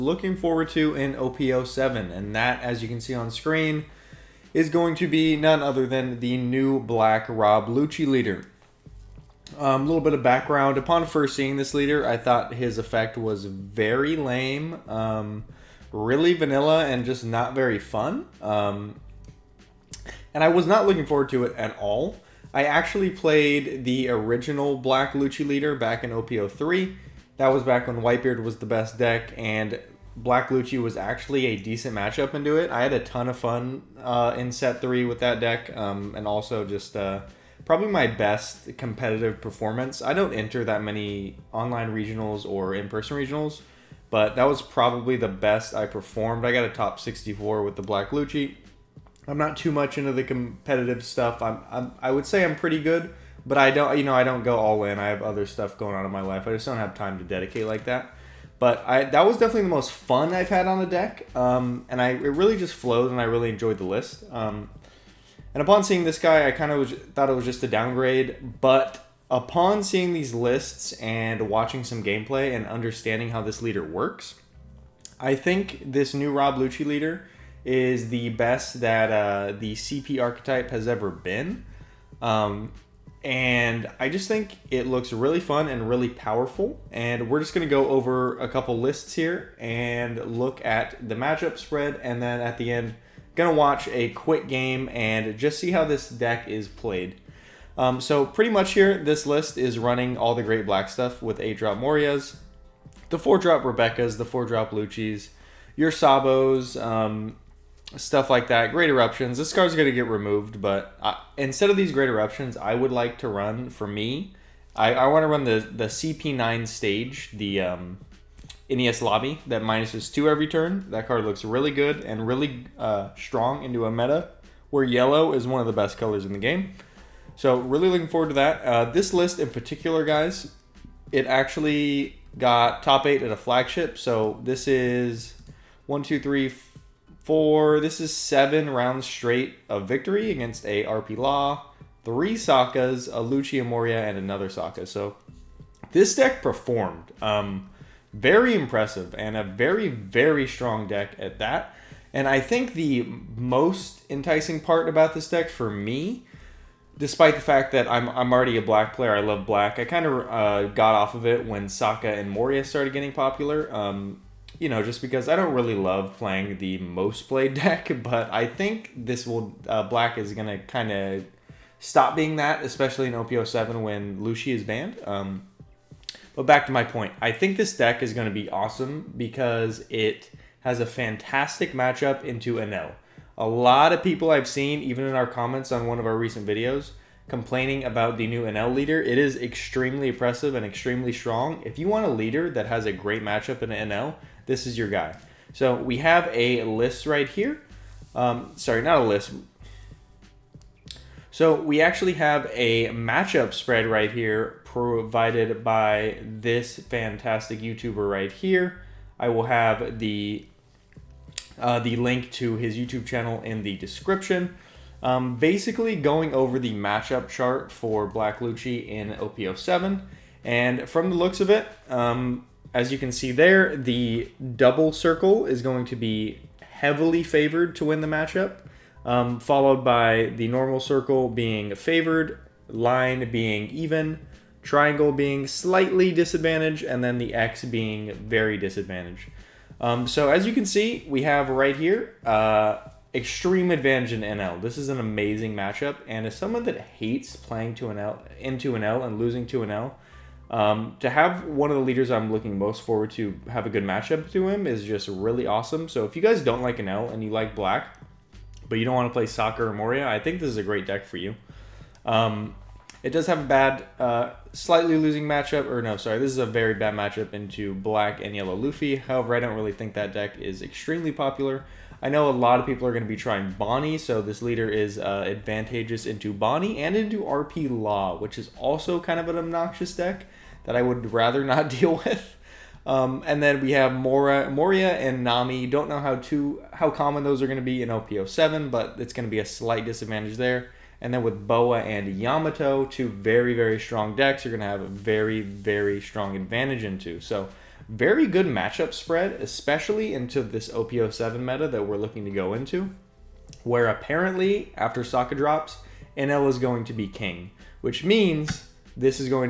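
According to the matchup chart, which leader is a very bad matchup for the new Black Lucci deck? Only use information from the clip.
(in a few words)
Black and yellow Luffy.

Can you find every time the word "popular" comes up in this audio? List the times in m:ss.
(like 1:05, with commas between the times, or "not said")
2:43, 4:31.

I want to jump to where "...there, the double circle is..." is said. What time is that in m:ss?
3:43.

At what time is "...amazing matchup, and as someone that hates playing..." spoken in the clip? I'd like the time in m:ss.
4:04.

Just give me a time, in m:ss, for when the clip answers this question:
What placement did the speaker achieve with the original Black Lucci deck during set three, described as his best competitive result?
0:46.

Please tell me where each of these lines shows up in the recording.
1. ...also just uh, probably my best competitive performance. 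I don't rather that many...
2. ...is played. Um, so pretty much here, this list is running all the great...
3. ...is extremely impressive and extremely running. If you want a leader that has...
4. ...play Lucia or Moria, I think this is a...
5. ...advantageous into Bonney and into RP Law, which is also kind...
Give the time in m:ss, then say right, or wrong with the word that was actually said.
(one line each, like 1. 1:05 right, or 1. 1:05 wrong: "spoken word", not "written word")
1. 0:36 wrong: "enter", not "rather"
2. 1:36 right
3. 3:09 wrong: "strong", not "running"
4. 4:19 wrong: "Soccer", not "Lucia"
5. 4:35 right.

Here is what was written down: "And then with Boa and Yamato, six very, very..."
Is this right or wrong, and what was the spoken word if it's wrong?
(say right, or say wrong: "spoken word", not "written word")
wrong: "two", not "six".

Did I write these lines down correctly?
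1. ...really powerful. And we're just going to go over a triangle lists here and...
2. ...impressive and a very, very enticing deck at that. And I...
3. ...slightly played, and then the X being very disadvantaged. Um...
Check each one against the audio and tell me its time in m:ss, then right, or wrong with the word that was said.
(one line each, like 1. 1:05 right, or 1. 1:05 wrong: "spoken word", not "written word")
1. 1:25 wrong: "couple", not "triangle"
2. 2:28 wrong: "strong", not "enticing"
3. 3:55 wrong: "disadvantaged", not "played".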